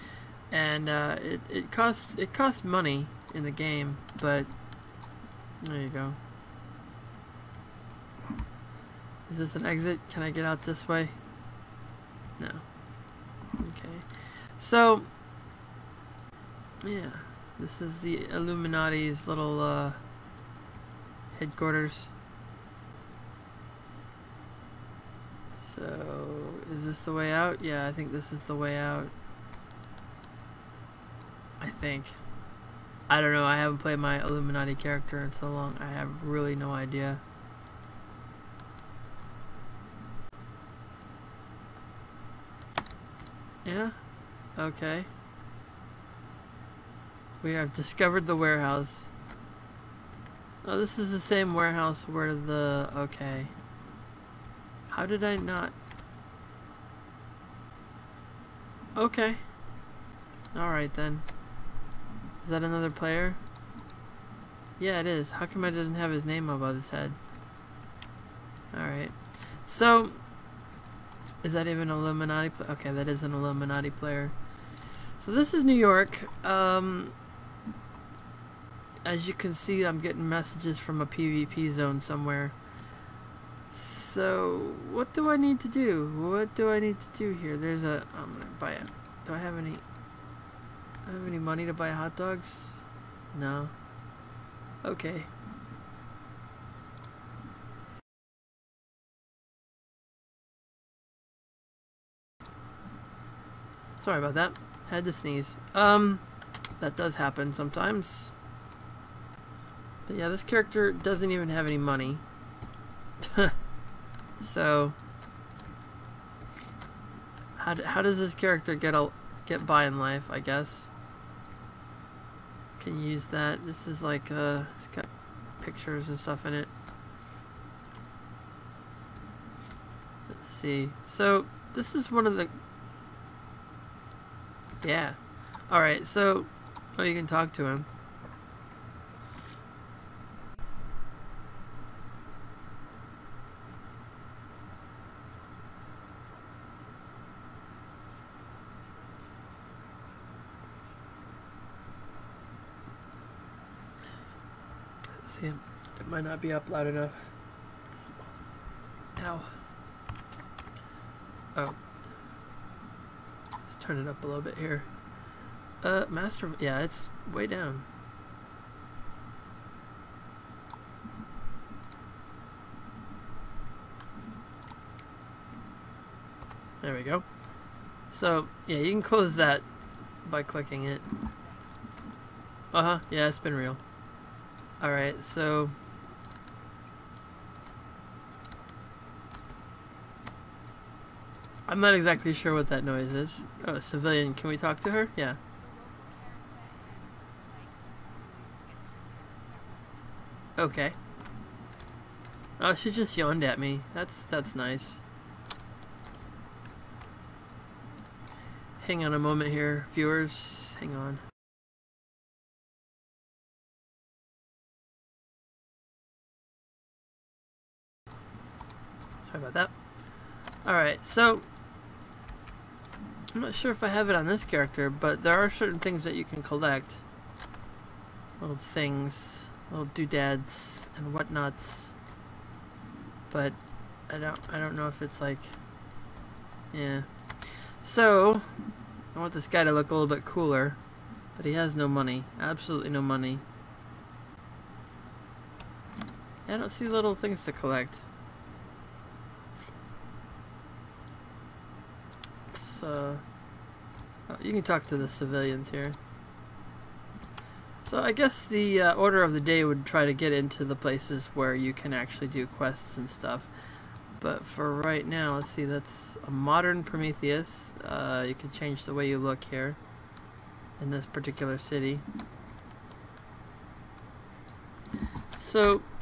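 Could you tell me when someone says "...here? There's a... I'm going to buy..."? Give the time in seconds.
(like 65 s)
87 s.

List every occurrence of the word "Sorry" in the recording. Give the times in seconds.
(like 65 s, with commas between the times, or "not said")
104 s, 219 s.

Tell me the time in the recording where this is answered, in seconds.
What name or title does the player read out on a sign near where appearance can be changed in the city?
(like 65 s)
266 s.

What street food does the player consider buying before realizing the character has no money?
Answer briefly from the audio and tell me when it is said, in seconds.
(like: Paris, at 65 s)
Hot dogs, at 91 s.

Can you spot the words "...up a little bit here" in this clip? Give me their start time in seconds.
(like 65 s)
164 s.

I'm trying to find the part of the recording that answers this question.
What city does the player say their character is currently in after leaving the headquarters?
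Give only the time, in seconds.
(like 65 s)
75 s.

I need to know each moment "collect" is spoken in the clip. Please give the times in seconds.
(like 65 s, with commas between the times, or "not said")
226 s, 247 s.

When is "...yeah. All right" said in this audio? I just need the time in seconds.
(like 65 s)
134 s.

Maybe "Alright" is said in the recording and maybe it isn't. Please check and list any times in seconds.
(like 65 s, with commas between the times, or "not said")
60 s, 68 s, 184 s, 220 s.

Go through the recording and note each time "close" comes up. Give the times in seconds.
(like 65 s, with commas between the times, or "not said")
179 s.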